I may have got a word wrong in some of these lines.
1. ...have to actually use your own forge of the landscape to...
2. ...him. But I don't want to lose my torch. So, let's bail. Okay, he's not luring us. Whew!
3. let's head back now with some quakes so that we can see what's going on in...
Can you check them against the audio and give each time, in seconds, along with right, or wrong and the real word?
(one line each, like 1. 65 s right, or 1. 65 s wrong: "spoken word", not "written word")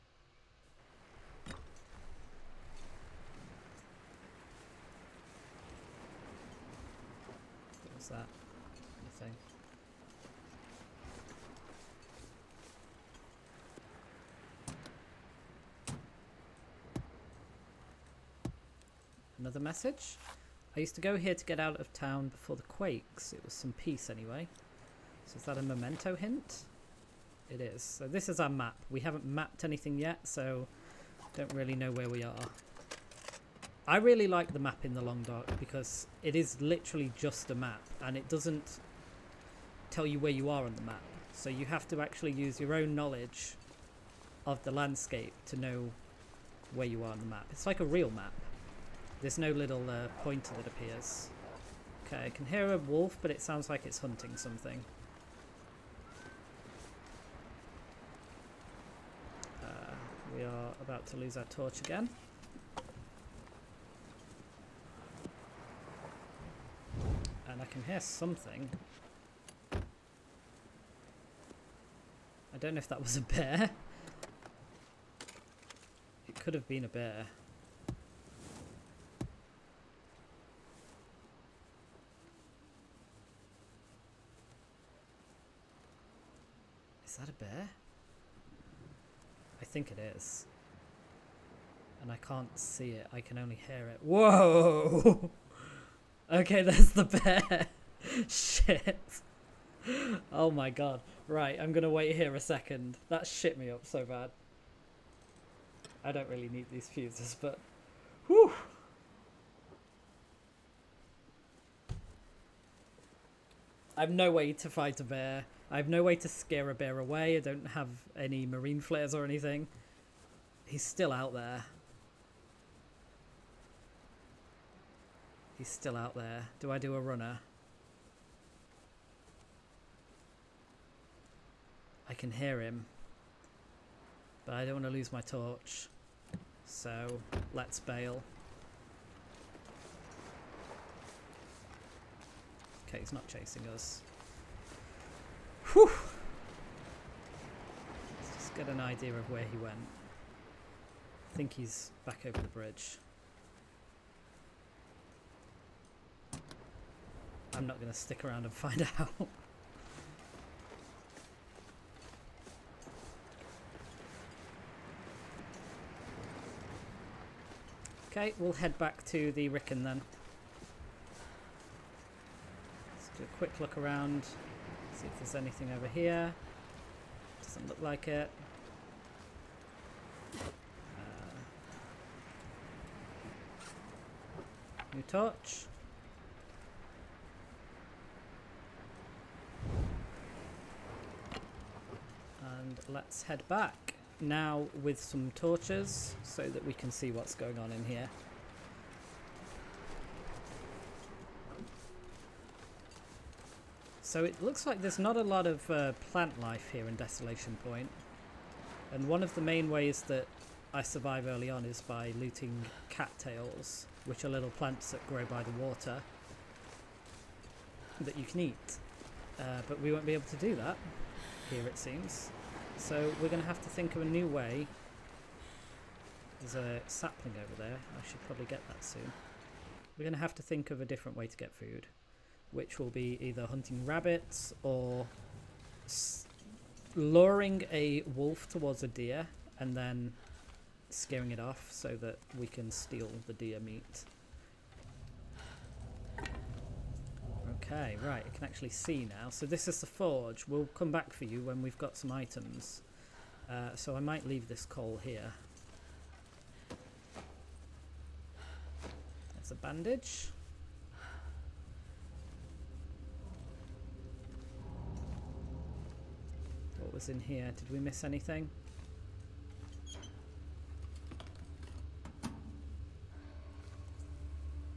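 1. 41 s wrong: "knowledge", not "forge"
2. 132 s wrong: "chasing", not "luring"
3. 192 s wrong: "torches", not "quakes".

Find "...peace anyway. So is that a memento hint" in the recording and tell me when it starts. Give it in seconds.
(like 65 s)
23 s.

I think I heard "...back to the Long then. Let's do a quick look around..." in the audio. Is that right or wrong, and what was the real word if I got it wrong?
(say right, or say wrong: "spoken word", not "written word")
wrong: "Riken", not "Long".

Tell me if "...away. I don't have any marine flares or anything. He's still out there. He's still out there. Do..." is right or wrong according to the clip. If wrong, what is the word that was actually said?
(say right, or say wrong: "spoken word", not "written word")
right.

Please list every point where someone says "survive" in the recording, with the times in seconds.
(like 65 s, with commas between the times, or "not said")
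210 s.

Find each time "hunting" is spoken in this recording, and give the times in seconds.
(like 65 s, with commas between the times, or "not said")
53 s, 233 s.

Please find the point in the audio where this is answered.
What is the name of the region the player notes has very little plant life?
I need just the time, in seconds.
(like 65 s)
206 s.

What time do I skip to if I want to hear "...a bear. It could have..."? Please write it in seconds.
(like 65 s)
73 s.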